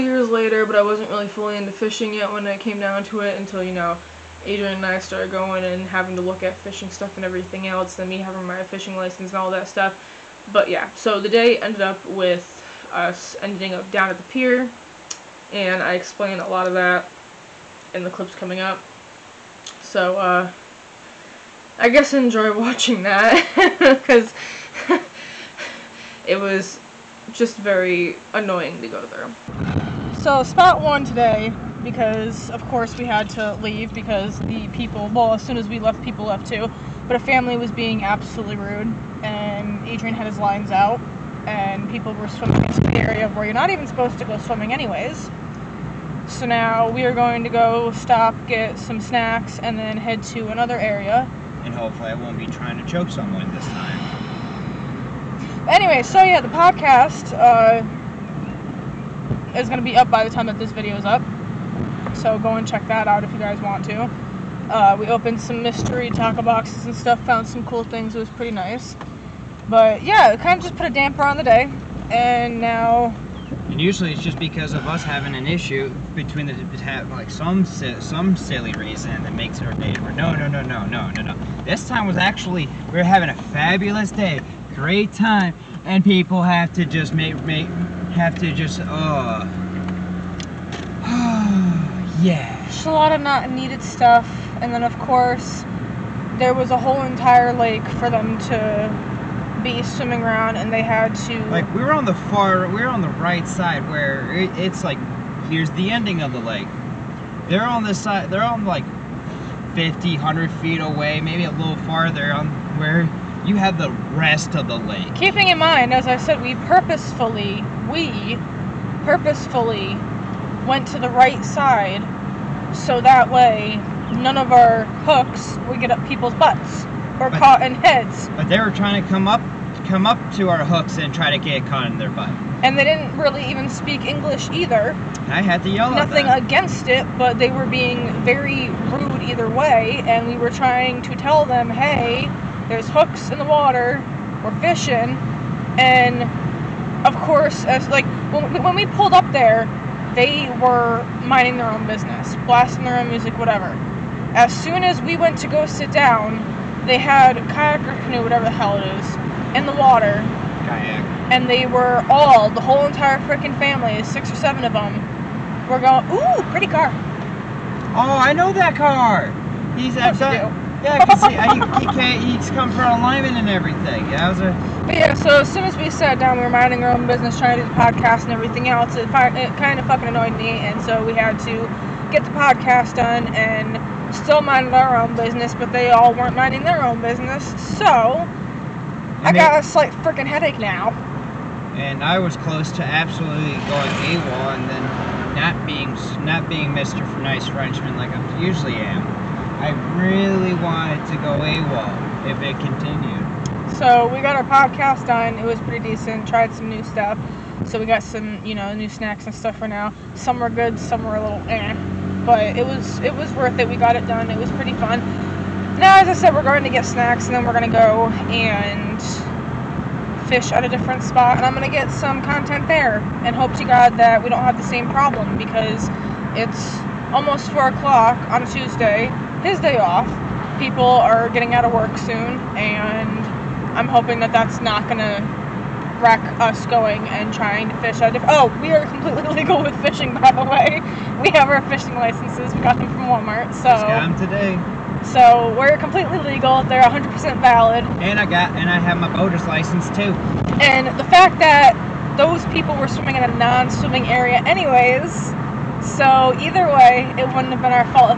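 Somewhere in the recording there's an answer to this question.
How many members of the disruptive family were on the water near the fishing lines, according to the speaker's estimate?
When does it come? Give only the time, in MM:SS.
02:44.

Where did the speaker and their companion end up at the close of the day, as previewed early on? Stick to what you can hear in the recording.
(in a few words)
the pier.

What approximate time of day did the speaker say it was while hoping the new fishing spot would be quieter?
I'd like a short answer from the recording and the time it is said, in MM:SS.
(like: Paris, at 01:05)
4 o'clock, at 03:47.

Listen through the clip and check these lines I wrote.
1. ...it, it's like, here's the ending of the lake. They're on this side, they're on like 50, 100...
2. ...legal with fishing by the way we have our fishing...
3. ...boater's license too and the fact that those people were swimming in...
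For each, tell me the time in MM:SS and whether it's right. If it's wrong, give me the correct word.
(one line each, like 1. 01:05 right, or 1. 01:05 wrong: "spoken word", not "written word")
1. 01:44 right
2. 03:59 right
3. 04:09 right.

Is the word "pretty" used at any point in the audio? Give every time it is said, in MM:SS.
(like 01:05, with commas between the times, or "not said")
01:08, 02:46, 03:25, 03:34.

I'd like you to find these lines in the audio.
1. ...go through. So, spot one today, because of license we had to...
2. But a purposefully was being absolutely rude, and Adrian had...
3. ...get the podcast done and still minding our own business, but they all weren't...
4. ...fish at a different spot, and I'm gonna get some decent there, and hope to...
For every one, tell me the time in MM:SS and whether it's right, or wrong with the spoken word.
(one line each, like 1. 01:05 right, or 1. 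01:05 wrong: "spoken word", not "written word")
1. 00:28 wrong: "course", not "license"
2. 00:37 wrong: "family", not "purposefully"
3. 03:02 right
4. 03:40 wrong: "content", not "decent".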